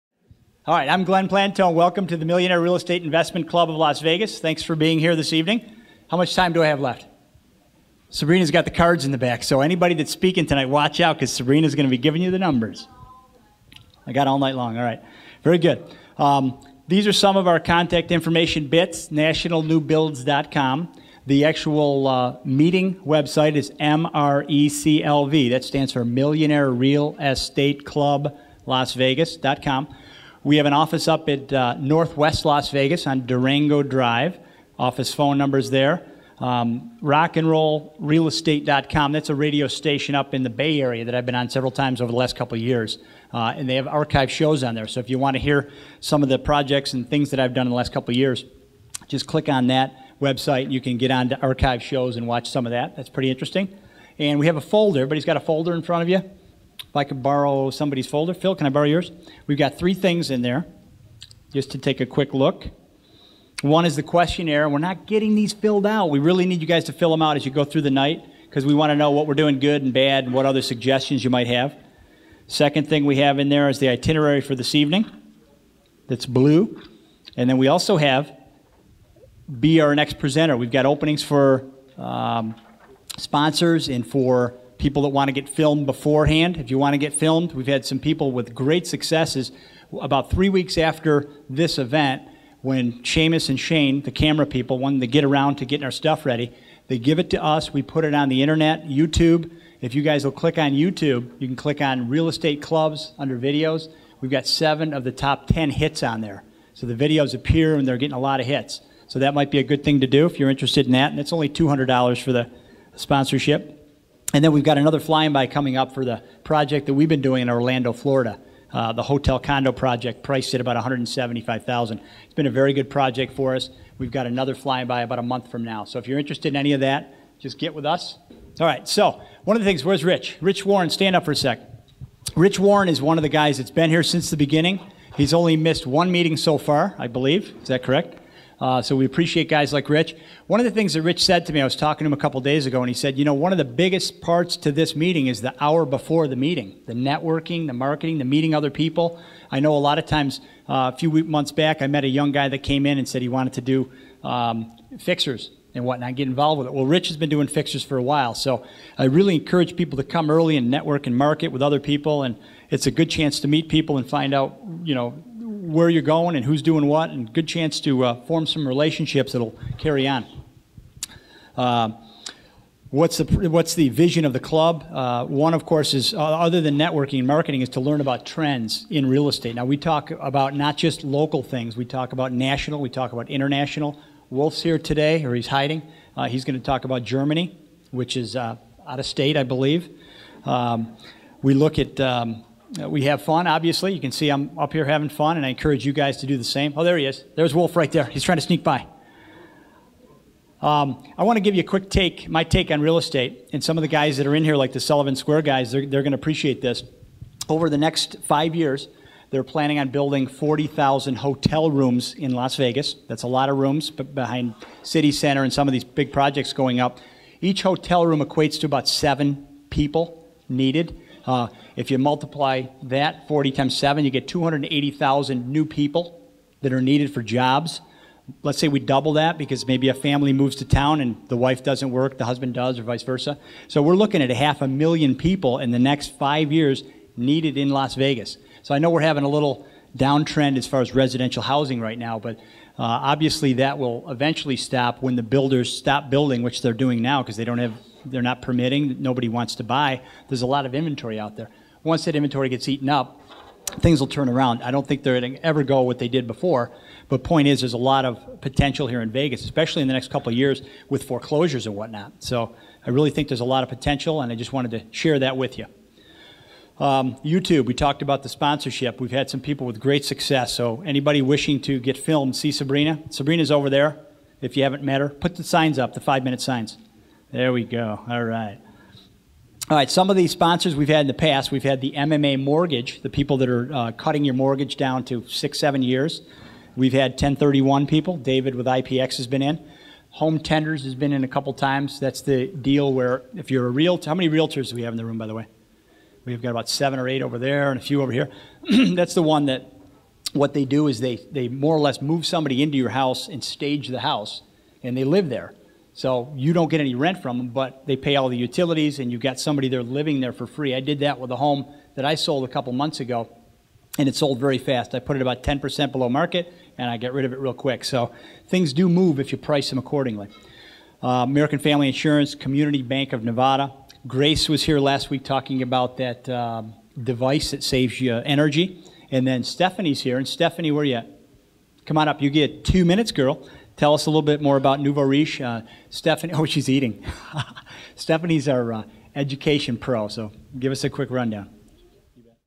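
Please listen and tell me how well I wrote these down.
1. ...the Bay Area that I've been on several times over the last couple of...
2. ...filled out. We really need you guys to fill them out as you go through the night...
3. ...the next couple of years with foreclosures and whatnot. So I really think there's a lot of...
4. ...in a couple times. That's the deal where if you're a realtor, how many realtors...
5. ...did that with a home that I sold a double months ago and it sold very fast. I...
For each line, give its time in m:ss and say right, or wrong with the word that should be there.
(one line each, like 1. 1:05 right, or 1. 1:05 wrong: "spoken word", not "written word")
1. 0:40 right
2. 1:05 right
3. 4:19 right
4. 4:51 right
5. 5:10 wrong: "couple", not "double".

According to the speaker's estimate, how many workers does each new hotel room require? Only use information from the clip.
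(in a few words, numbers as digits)
7.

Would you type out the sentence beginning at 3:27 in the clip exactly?
Over the next five years, they're planning on building 40,000 hotel rooms in Las Vegas.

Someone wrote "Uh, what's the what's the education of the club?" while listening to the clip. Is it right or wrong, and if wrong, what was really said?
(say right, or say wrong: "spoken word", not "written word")
wrong: "vision", not "education".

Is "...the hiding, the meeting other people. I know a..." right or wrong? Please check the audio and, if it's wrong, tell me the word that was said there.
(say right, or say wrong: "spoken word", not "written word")
wrong: "marketing", not "hiding".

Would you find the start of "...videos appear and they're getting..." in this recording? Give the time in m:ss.
1:46.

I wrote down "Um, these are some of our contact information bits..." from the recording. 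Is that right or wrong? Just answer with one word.
right.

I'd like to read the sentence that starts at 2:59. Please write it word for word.
Now we talk about not just local things; we talk about national, we talk about international.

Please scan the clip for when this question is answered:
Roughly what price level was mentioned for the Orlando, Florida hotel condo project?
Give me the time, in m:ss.
2:00.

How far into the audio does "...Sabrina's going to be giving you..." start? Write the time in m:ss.
0:11.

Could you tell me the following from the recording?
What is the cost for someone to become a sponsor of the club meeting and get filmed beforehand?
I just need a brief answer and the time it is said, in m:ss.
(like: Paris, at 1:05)
$200, at 1:51.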